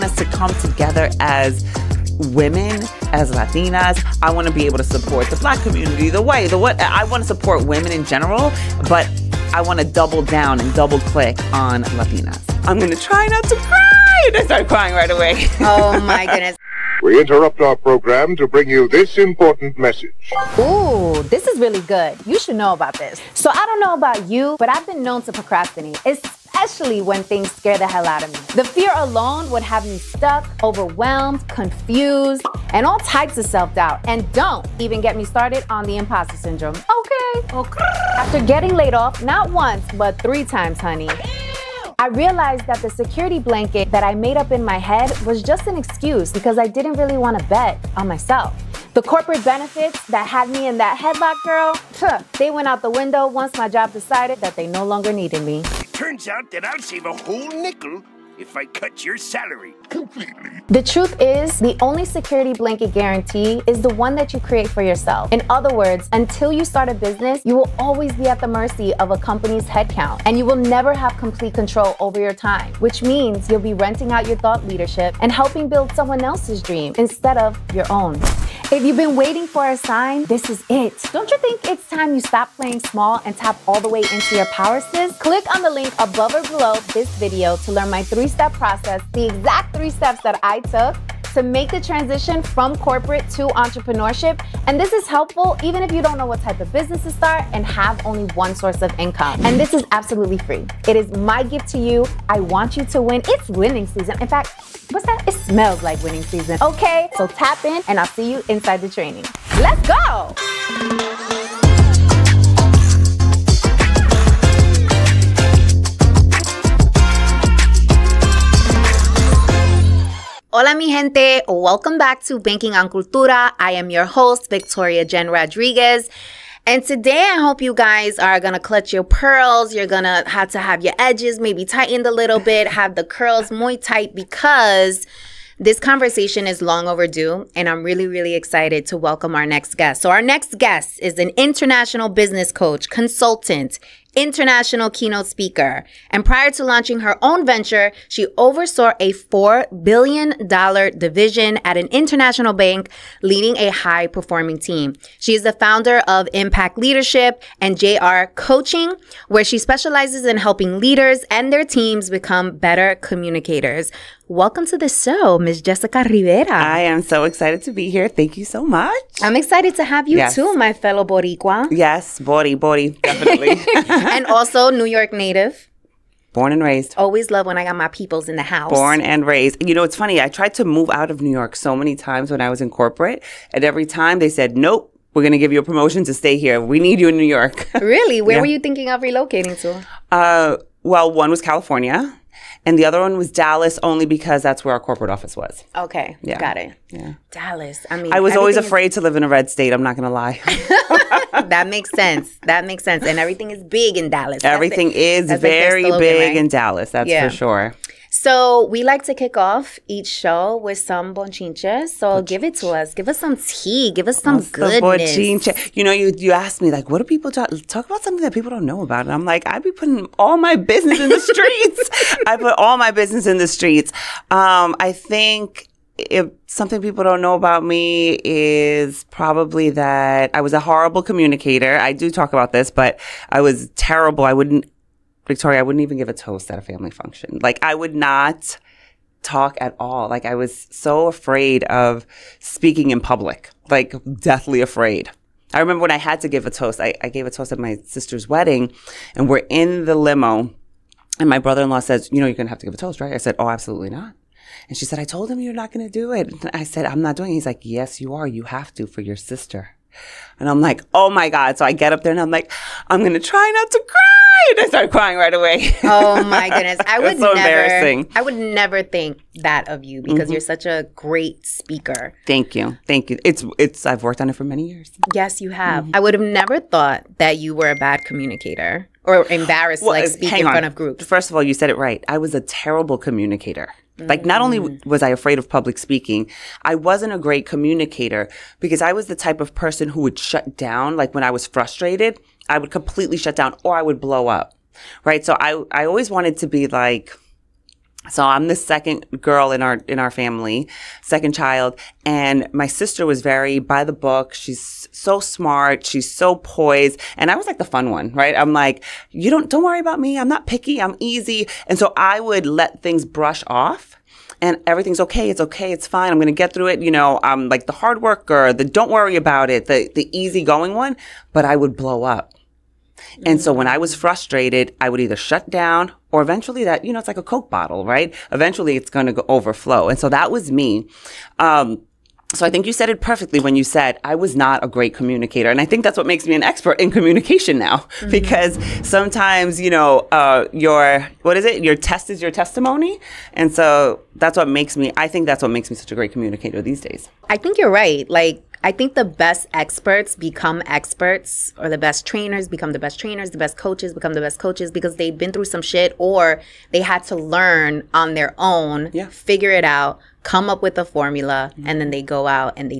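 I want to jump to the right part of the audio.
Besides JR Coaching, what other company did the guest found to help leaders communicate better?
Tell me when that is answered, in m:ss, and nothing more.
2:36.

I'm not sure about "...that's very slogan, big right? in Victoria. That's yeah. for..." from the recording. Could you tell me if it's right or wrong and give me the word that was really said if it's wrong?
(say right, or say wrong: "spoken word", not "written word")
wrong: "Dallas", not "Victoria".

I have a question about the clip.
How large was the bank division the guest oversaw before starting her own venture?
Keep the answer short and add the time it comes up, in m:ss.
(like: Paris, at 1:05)
$4 billion, at 2:29.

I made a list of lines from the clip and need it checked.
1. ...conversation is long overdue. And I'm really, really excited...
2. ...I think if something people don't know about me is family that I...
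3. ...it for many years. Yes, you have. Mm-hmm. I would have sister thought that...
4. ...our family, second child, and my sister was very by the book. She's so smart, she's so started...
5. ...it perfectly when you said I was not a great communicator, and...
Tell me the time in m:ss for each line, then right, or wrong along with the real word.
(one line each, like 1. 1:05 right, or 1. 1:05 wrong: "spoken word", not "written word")
1. 2:15 right
2. 3:44 wrong: "probably", not "family"
3. 4:34 wrong: "never", not "sister"
4. 4:59 wrong: "poised", not "started"
5. 5:32 right.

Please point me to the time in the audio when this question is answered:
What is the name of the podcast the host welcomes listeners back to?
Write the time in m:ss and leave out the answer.
2:02.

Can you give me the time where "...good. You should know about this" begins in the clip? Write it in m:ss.
0:21.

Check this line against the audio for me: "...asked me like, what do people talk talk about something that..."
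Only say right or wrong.
right.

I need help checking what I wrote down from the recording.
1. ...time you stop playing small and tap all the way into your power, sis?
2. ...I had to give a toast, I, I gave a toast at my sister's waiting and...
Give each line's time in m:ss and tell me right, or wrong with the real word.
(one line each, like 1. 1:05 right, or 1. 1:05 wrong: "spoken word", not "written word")
1. 1:21 right
2. 4:05 wrong: "wedding", not "waiting".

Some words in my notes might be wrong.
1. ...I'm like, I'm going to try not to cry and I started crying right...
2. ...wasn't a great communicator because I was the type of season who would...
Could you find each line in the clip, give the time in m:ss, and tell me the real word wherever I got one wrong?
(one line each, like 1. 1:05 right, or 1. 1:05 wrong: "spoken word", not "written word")
1. 4:22 right
2. 4:46 wrong: "person", not "season".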